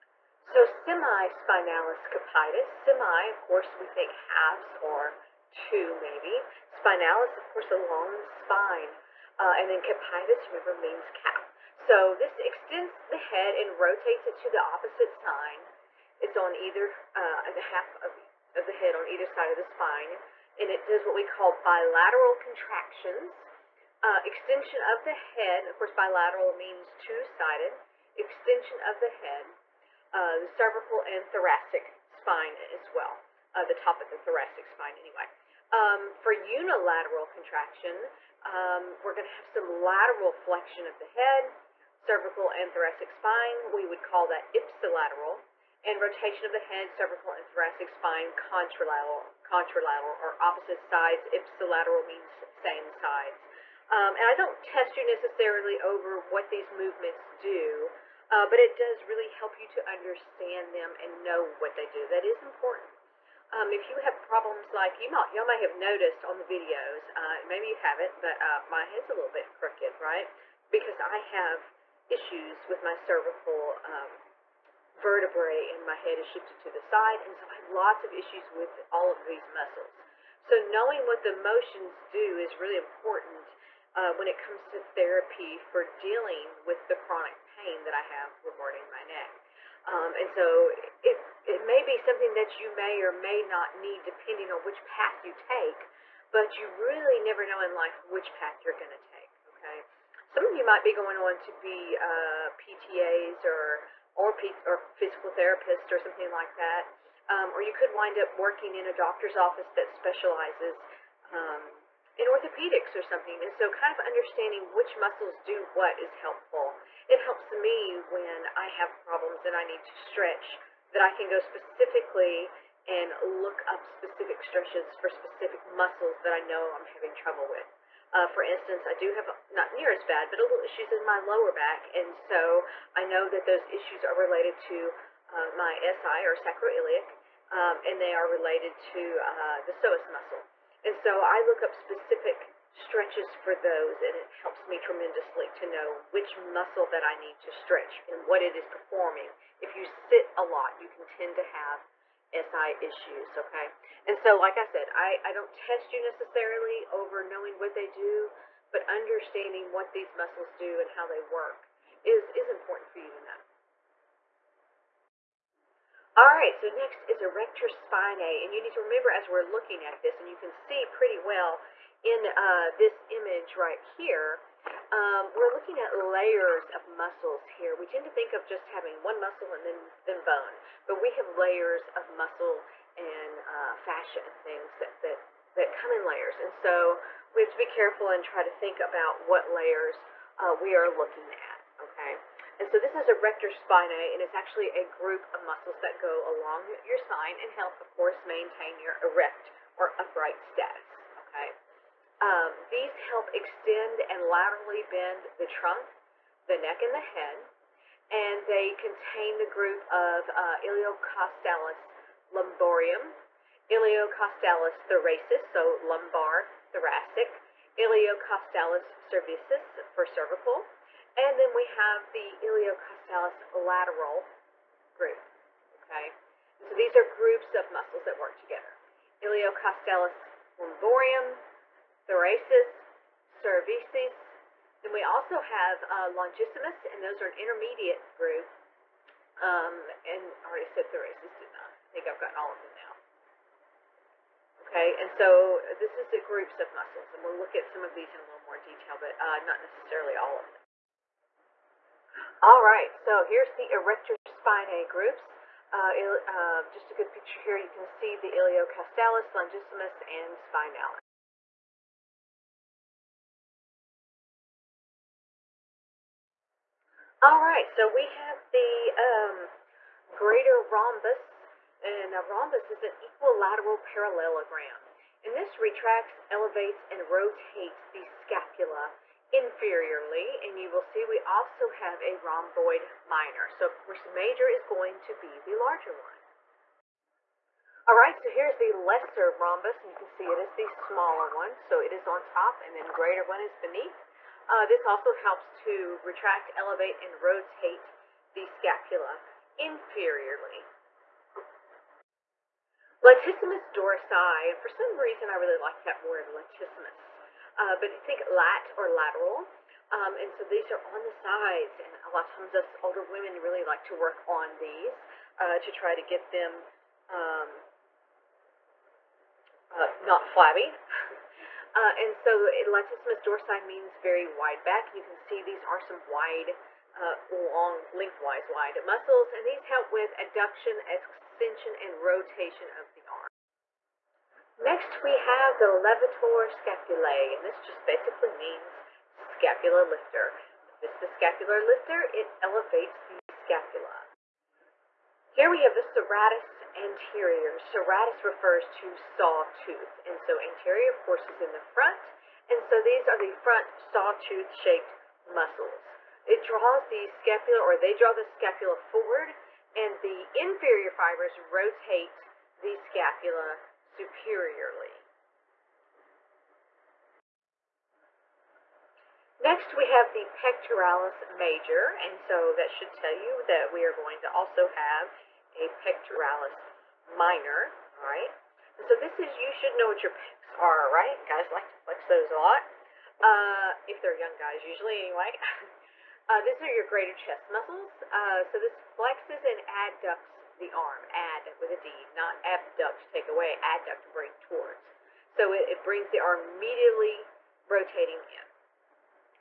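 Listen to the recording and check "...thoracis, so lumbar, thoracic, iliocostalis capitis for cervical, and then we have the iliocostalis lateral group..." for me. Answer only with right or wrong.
wrong.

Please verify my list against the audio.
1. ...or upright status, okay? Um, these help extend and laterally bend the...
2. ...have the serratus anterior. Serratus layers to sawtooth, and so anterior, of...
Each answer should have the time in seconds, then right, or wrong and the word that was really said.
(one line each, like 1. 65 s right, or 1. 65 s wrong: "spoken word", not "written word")
1. 199 s right
2. 345 s wrong: "refers", not "layers".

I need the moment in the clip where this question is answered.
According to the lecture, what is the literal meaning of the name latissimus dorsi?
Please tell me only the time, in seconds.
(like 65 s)
323 s.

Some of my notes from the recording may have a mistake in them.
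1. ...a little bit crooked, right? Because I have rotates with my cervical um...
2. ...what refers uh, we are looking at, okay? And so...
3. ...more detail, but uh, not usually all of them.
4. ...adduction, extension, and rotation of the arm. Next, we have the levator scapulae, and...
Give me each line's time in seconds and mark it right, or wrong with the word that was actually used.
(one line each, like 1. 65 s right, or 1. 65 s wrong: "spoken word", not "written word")
1. 69 s wrong: "issues", not "rotates"
2. 189 s wrong: "layers", not "refers"
3. 248 s wrong: "necessarily", not "usually"
4. 330 s right.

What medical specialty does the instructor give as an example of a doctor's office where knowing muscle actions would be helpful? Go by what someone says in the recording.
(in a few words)
orthopedics.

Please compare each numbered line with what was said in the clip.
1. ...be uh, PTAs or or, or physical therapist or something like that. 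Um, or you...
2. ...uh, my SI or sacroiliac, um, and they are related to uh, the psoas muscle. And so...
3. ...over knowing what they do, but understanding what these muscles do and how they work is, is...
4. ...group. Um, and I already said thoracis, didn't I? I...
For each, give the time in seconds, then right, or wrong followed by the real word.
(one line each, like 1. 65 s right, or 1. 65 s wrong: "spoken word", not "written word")
1. 101 s right
2. 135 s right
3. 156 s right
4. 238 s right.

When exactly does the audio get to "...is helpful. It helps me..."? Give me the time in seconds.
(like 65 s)
115 s.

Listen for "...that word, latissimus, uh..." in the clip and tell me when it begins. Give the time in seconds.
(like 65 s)
305 s.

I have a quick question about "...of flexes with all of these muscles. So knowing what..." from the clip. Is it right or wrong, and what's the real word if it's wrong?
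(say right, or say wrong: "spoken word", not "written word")
wrong: "issues", not "flexes".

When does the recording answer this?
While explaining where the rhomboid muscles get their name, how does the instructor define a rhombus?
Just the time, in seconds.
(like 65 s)
273 s.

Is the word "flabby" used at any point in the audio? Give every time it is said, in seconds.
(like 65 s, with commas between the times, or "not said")
320 s.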